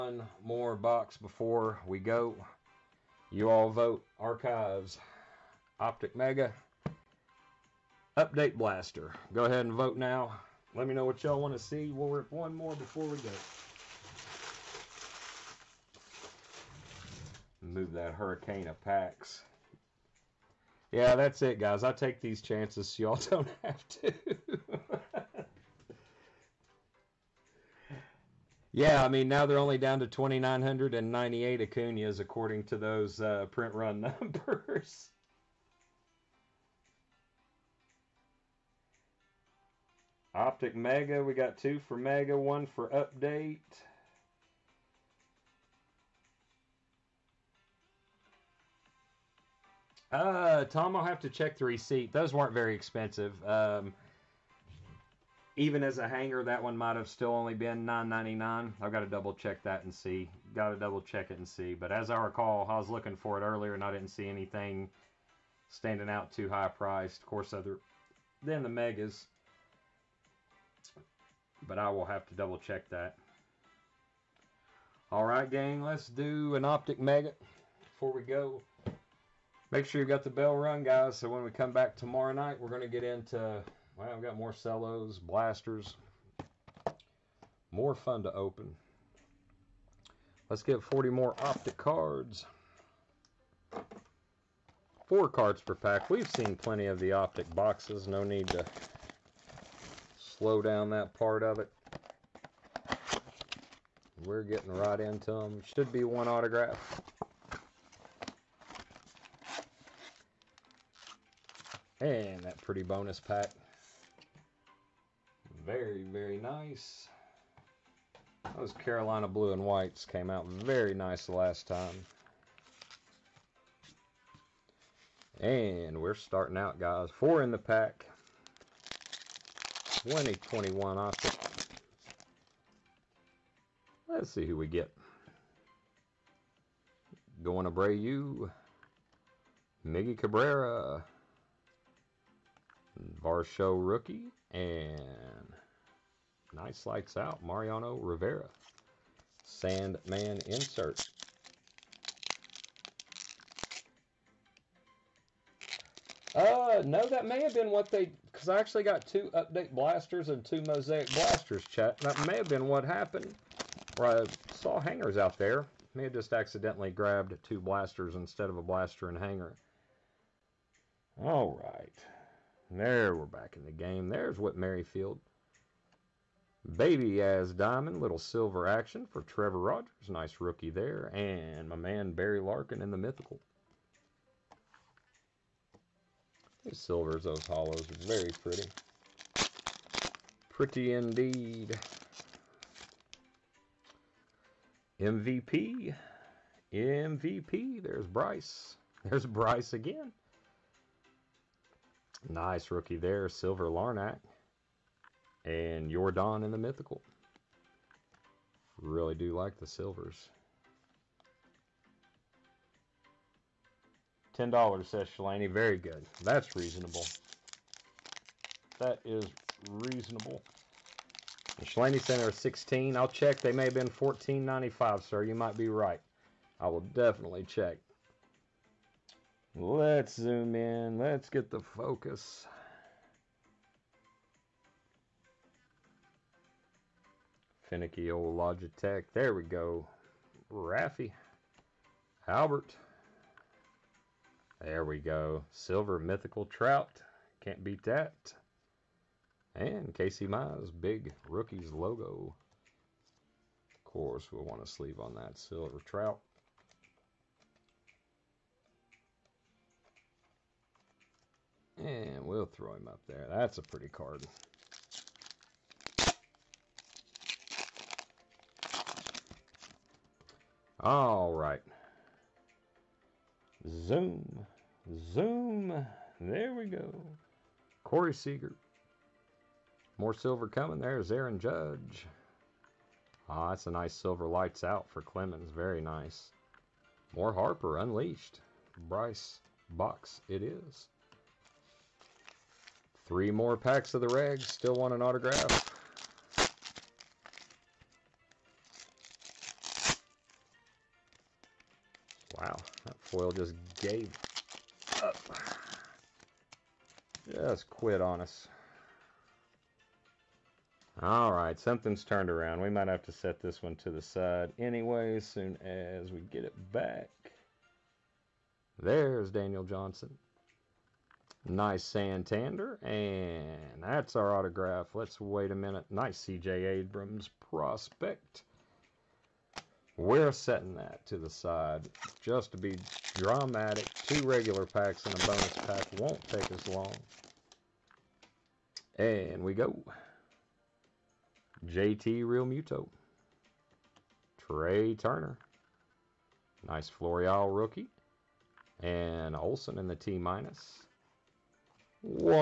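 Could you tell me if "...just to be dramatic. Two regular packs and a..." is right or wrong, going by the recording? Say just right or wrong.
right.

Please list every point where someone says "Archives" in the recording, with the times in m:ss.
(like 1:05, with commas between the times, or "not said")
0:04.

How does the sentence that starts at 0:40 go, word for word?
Optic Mega, we got two for Mega, one for Update.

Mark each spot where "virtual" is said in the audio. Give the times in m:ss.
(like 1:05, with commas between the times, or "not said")
not said.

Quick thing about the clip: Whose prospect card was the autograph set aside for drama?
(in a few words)
CJ Abrams.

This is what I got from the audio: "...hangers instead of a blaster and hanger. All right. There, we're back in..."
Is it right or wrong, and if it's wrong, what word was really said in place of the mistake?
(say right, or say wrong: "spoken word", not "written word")
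wrong: "blasters", not "hangers".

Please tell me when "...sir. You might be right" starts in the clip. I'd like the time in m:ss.
3:45.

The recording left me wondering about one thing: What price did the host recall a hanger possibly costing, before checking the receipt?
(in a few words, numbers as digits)
$9.99.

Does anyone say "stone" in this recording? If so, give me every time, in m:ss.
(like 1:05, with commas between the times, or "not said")
not said.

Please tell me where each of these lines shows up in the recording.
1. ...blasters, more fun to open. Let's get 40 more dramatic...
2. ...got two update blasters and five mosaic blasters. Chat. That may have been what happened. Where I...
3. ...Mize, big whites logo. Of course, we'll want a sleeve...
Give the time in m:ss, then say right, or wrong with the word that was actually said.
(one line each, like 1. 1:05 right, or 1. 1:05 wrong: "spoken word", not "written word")
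1. 1:25 wrong: "optic", not "dramatic"
2. 2:38 wrong: "two", not "five"
3. 4:10 wrong: "rookies", not "whites".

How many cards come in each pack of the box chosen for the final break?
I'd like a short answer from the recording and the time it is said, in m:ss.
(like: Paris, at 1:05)
4, at 1:35.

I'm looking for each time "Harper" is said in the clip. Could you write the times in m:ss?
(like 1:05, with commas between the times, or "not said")
4:47.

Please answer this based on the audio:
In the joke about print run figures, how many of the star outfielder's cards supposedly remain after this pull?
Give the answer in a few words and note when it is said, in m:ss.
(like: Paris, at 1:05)
2,998, at 0:30.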